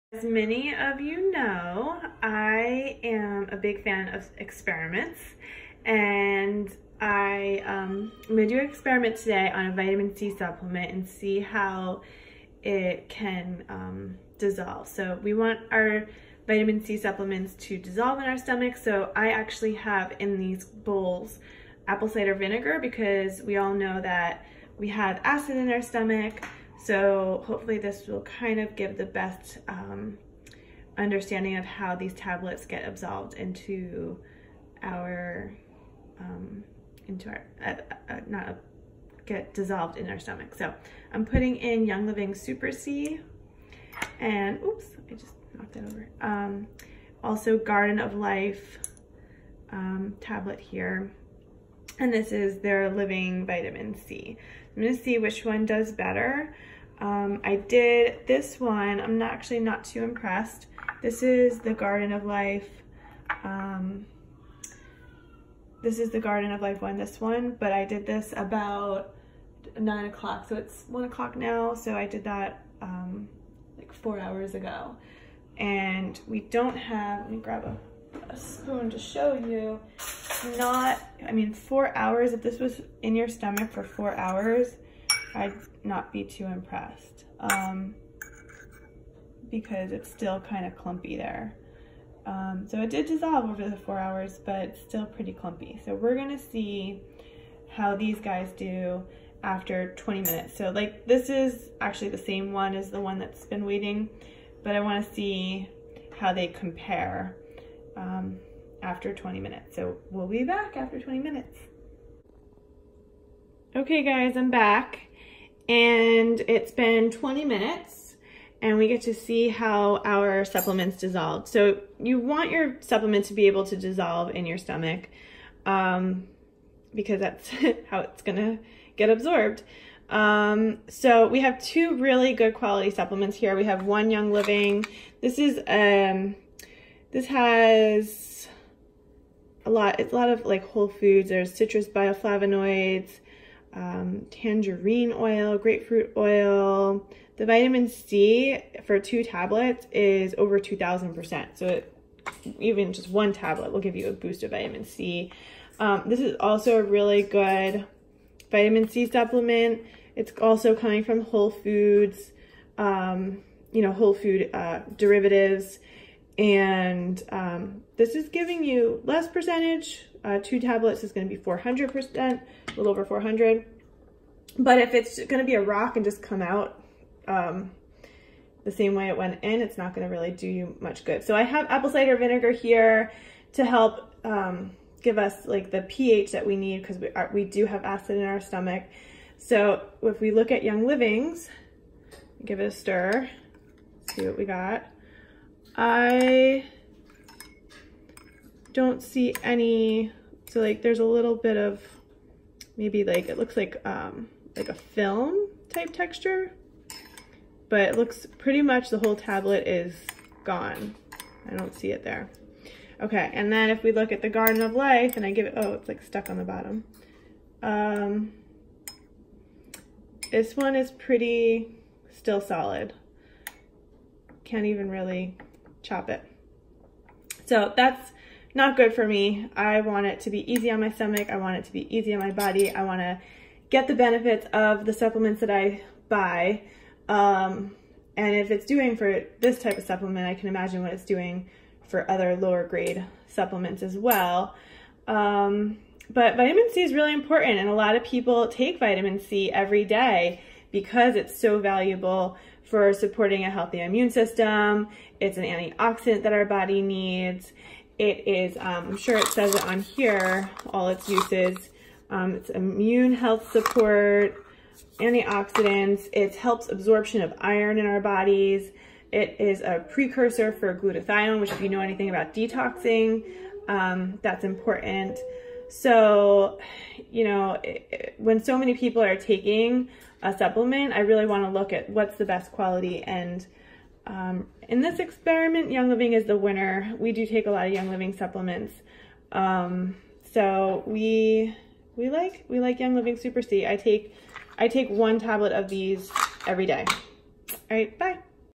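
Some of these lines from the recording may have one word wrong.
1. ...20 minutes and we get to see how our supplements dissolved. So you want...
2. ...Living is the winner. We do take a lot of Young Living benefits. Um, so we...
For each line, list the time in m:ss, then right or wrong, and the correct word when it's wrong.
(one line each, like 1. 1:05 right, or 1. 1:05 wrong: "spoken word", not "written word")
1. 1:57 right
2. 4:45 wrong: "supplements", not "benefits".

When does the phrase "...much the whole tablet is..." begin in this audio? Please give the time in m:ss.
3:28.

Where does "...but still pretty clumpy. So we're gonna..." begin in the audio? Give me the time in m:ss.
1:34.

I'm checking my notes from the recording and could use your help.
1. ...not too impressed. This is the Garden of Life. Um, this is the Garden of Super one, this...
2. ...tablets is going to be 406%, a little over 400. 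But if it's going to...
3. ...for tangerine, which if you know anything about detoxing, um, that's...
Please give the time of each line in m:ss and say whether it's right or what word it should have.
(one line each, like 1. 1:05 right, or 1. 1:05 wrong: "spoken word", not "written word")
1. 0:59 wrong: "Life", not "Super"
2. 2:50 wrong: "400", not "406"
3. 4:30 wrong: "glutathione", not "tangerine".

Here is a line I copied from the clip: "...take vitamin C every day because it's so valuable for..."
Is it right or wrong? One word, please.
right.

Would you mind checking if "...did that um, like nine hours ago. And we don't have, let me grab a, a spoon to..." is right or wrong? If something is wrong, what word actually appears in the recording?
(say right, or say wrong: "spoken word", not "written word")
wrong: "four", not "nine".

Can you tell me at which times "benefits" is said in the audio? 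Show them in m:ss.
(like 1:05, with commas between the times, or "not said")
3:53.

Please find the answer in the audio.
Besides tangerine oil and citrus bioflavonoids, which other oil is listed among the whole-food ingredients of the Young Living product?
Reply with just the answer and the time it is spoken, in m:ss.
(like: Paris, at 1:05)
Grapefruit oil, at 2:25.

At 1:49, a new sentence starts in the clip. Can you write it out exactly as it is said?
So we'll be back after 20 minutes.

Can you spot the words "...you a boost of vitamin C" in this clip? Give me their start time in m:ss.
2:33.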